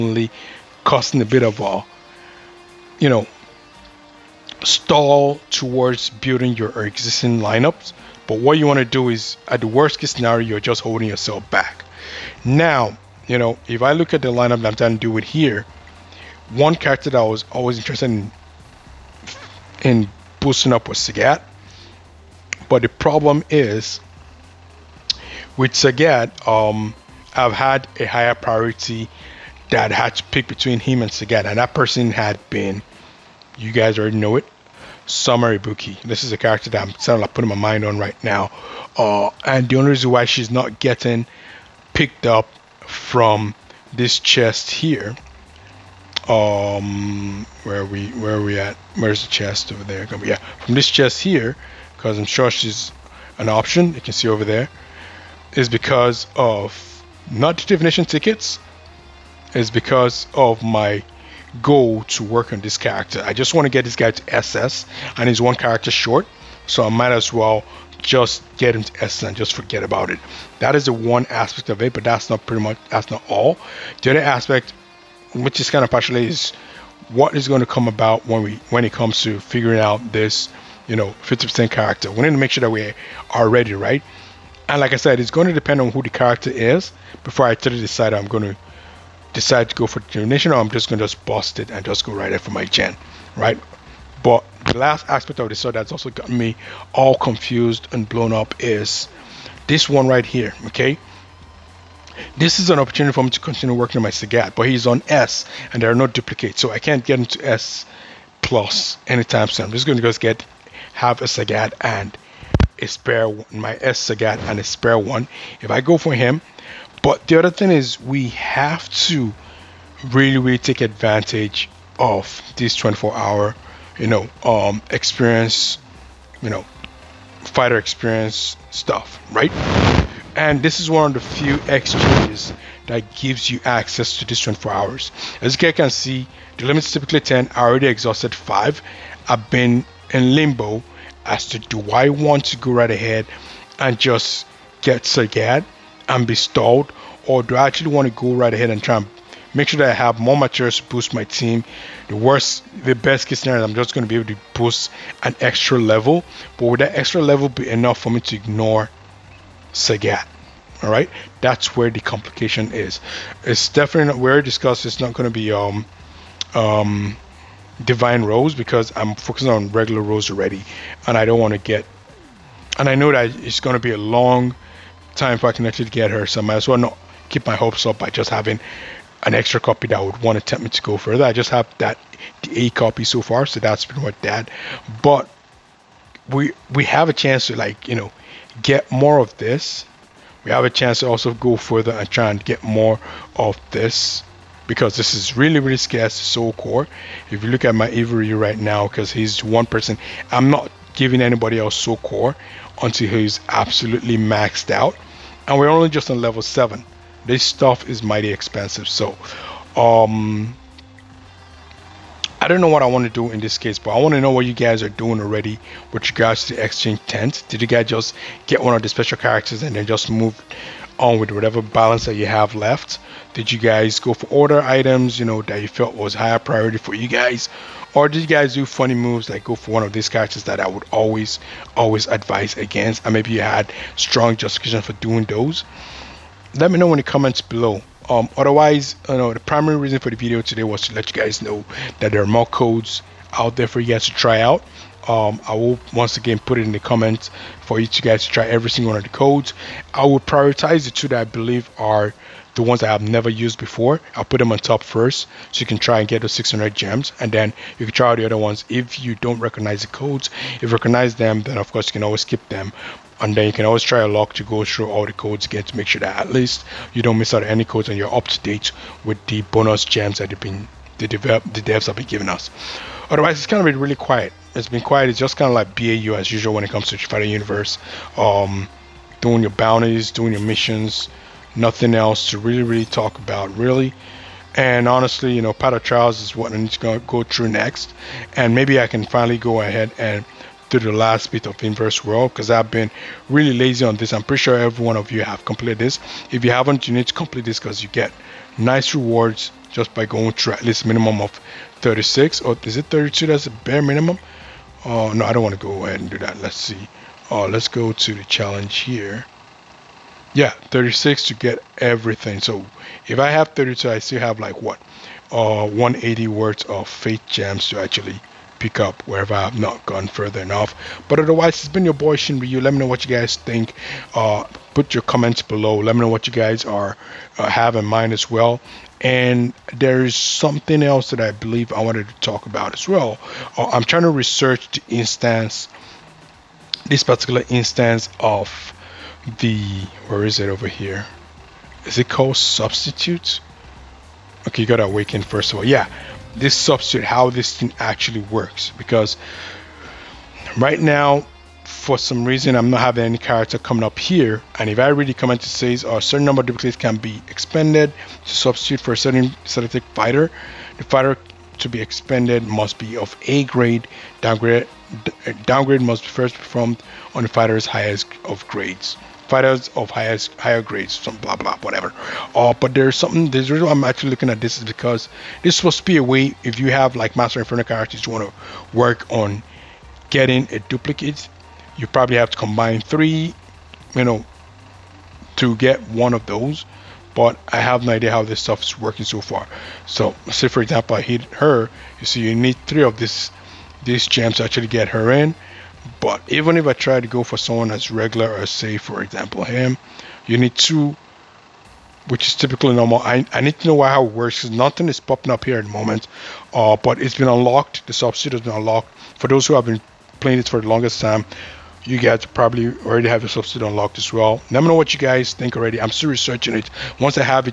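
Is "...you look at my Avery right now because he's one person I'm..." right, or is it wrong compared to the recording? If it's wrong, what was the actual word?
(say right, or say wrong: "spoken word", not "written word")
right.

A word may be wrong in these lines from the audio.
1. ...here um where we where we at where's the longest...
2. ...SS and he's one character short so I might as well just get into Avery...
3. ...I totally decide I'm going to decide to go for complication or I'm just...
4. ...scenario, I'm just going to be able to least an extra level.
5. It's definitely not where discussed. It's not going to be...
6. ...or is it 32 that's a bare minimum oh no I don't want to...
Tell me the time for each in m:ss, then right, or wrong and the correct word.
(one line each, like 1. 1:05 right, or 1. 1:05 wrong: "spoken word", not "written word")
1. 0:44 wrong: "chest", not "longest"
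2. 1:04 wrong: "Essence", not "Avery"
3. 1:27 wrong: "determination", not "complication"
4. 2:33 wrong: "boost", not "least"
5. 2:43 right
6. 5:02 right.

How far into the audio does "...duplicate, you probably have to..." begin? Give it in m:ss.
6:20.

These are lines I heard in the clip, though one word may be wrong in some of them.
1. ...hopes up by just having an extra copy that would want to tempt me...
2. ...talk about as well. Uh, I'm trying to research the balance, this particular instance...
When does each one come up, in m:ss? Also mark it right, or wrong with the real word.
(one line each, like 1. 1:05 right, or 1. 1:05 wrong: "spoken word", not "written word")
1. 2:57 right
2. 5:32 wrong: "instance", not "balance".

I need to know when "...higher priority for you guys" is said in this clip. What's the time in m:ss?
3:46.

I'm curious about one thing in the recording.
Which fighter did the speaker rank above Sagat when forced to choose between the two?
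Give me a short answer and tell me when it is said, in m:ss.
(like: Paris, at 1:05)
Summer Ibuki, at 0:35.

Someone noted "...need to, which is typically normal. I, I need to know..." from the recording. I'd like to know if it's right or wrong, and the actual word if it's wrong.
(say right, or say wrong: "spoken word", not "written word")
right.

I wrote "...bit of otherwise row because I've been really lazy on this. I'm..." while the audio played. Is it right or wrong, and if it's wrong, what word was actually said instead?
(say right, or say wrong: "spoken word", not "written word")
wrong: "inverse", not "otherwise".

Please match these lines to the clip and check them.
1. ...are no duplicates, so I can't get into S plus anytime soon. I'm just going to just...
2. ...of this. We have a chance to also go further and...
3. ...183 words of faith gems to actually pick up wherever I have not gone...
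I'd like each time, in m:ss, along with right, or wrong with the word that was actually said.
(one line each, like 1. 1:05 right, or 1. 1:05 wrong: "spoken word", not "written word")
1. 1:45 right
2. 3:09 right
3. 5:15 wrong: "180", not "183".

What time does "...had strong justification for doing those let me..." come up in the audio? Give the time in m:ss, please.
3:53.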